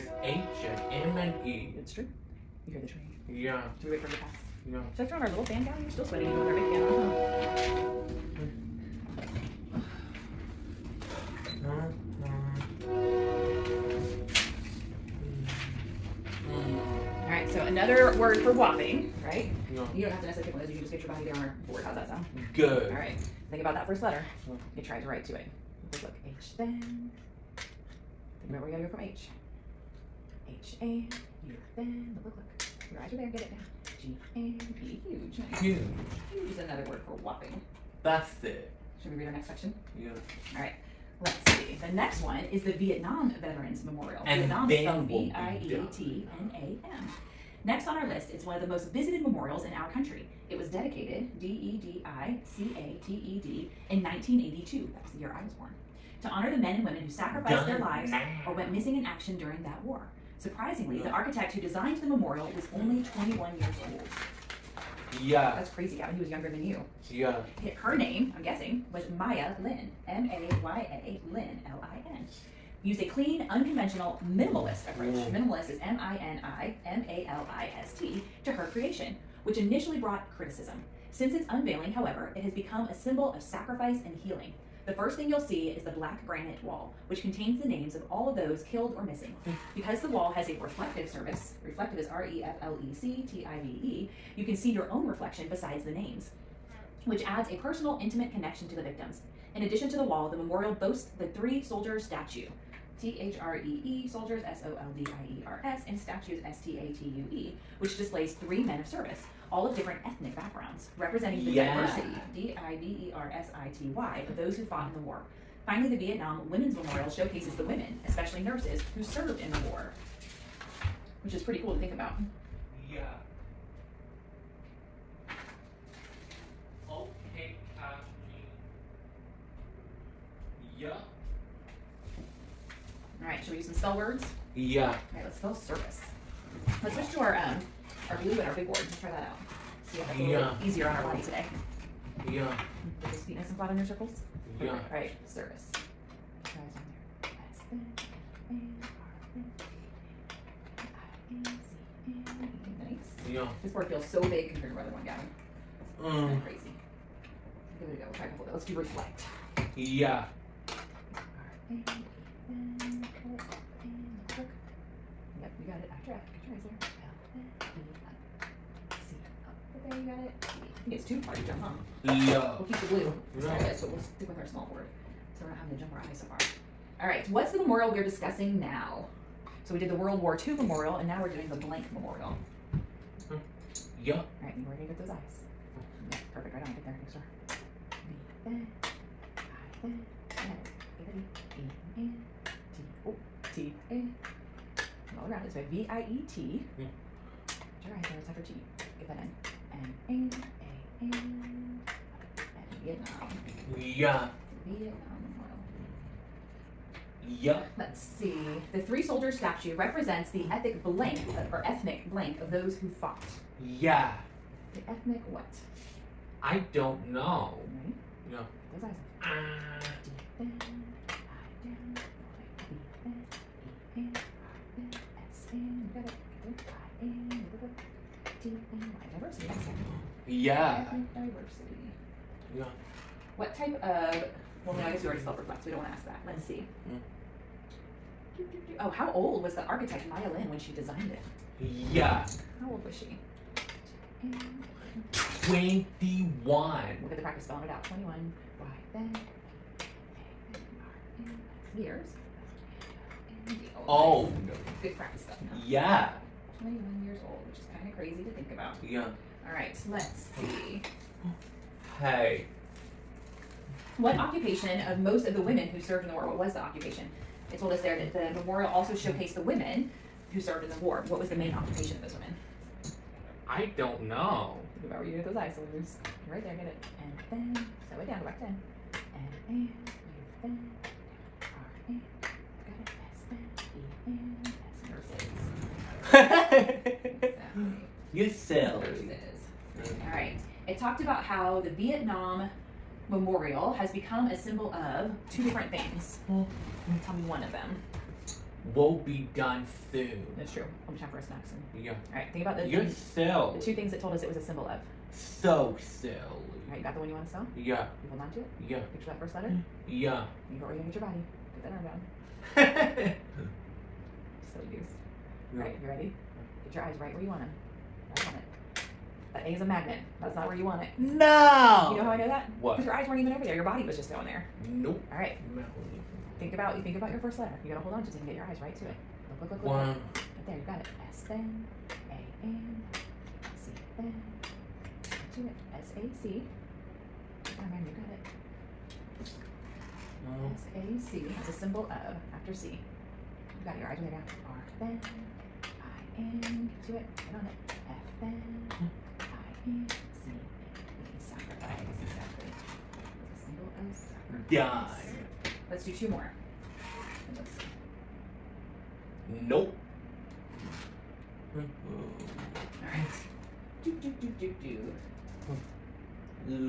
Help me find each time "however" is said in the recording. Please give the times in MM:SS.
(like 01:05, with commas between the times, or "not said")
01:21.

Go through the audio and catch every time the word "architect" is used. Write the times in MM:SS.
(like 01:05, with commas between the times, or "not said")
01:01, 03:59.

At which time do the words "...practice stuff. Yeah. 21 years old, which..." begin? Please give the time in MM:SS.
04:14.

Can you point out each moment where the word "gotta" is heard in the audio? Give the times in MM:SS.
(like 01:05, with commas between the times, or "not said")
00:28, 05:27.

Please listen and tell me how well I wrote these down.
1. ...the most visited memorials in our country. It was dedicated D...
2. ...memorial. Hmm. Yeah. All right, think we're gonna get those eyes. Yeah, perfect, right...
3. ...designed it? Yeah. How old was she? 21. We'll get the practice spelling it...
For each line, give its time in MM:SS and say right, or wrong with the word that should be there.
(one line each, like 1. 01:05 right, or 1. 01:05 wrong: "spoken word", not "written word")
1. 00:48 right
2. 03:01 right
3. 04:00 right.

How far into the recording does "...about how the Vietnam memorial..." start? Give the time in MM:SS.
04:51.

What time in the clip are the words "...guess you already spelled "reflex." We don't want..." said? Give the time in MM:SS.
03:54.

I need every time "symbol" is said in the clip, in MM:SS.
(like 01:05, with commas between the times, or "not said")
01:22, 04:54, 05:04, 05:41.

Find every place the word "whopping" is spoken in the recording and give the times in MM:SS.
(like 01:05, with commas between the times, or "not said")
00:18, 00:37.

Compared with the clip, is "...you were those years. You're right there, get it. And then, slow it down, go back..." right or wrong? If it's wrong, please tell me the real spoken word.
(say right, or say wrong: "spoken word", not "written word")
wrong: "isolators", not "years".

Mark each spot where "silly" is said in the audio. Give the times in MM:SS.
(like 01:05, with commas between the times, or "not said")
04:48, 05:05, 05:12.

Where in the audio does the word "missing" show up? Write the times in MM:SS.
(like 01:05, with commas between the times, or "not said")
00:58, 01:29.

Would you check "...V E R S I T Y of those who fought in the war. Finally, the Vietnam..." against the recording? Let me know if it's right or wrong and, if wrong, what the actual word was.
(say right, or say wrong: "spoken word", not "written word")
right.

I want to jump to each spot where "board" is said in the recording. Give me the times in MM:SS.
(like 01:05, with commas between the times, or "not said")
00:21, 02:18, 02:33, 02:54.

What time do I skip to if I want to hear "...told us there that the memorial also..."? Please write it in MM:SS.
04:27.